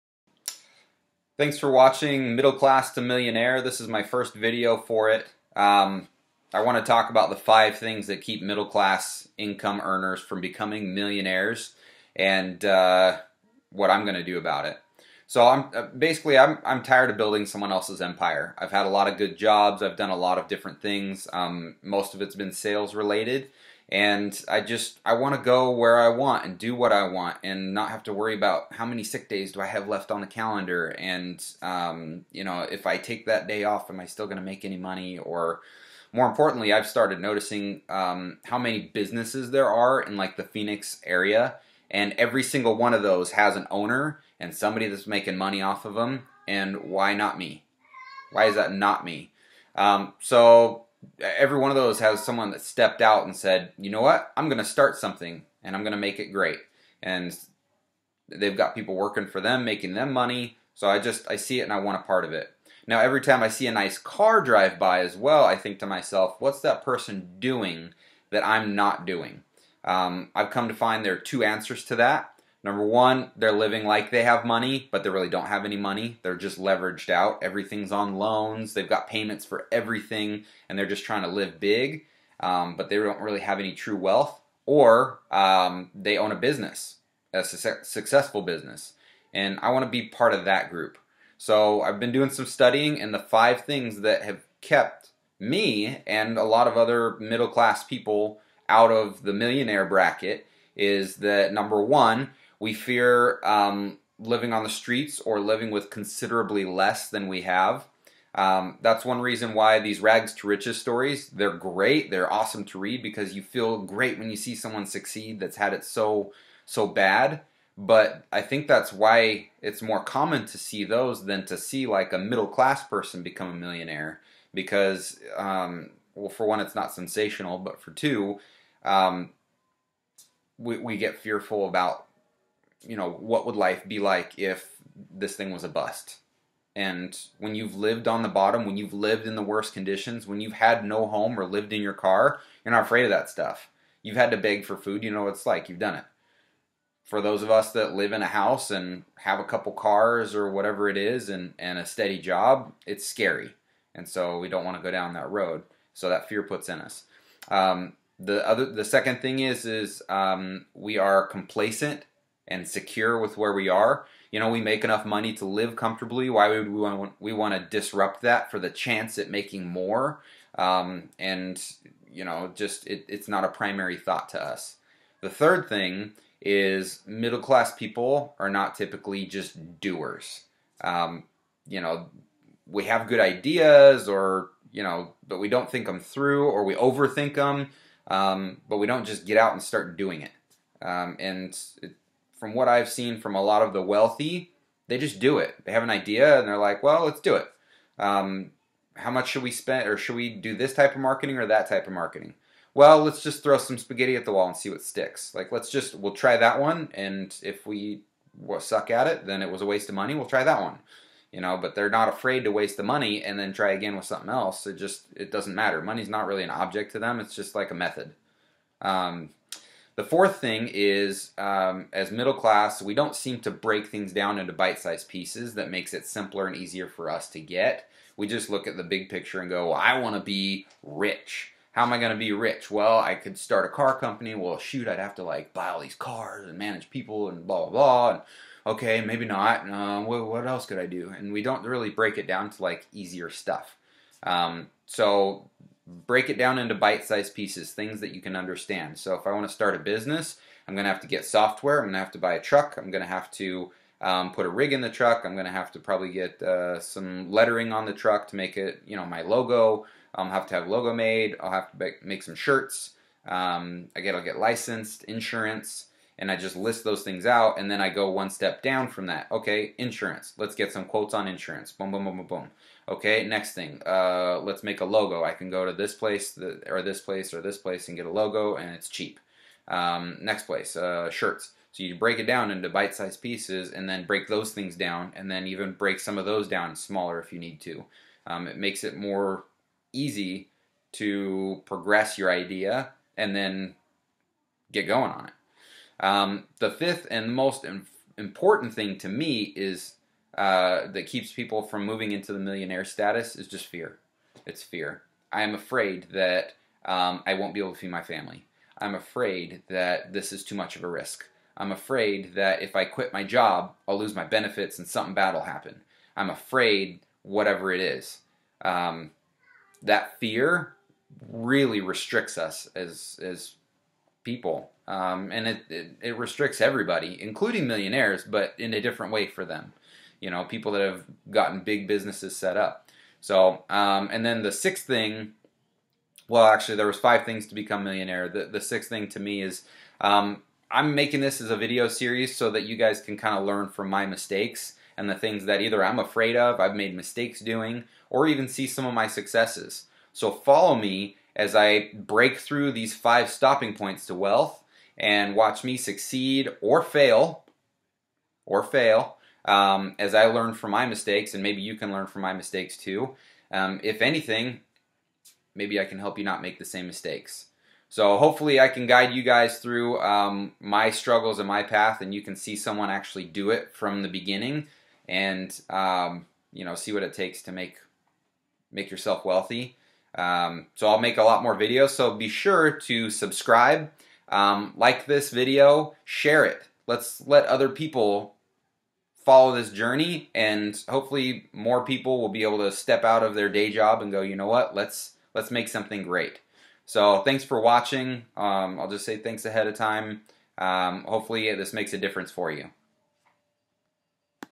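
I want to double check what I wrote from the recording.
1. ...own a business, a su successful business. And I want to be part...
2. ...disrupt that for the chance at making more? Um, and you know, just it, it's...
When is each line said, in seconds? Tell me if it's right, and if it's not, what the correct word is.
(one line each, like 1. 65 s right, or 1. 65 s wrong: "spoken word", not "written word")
1. 86 s right
2. 167 s right.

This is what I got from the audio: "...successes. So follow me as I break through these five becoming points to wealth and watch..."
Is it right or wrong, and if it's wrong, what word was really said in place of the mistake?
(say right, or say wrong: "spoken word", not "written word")
wrong: "stopping", not "becoming".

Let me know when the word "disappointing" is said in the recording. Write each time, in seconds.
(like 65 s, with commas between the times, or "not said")
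not said.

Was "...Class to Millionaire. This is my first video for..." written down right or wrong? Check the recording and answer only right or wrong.
right.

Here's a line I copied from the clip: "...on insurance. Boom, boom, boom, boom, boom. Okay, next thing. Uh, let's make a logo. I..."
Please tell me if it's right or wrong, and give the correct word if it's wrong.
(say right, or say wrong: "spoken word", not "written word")
right.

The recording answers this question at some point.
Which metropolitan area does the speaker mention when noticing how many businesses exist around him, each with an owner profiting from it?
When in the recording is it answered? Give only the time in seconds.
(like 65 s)
40 s.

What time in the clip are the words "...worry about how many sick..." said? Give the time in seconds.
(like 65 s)
28 s.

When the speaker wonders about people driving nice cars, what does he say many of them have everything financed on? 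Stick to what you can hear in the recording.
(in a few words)
Loans.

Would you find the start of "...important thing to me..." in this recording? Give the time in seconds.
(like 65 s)
298 s.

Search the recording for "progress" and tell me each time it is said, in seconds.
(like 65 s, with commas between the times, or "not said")
291 s.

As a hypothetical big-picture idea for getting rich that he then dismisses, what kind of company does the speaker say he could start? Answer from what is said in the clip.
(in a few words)
A car company.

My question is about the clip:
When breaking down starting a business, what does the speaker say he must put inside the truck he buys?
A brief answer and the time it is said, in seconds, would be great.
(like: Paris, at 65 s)
A rig, at 254 s.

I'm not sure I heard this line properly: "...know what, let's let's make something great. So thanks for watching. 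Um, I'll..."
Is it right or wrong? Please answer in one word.
right.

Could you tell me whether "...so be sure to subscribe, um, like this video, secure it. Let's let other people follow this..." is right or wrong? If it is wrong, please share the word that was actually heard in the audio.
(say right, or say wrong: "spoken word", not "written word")
wrong: "share", not "secure".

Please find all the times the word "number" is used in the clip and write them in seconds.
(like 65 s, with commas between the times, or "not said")
72 s, 101 s.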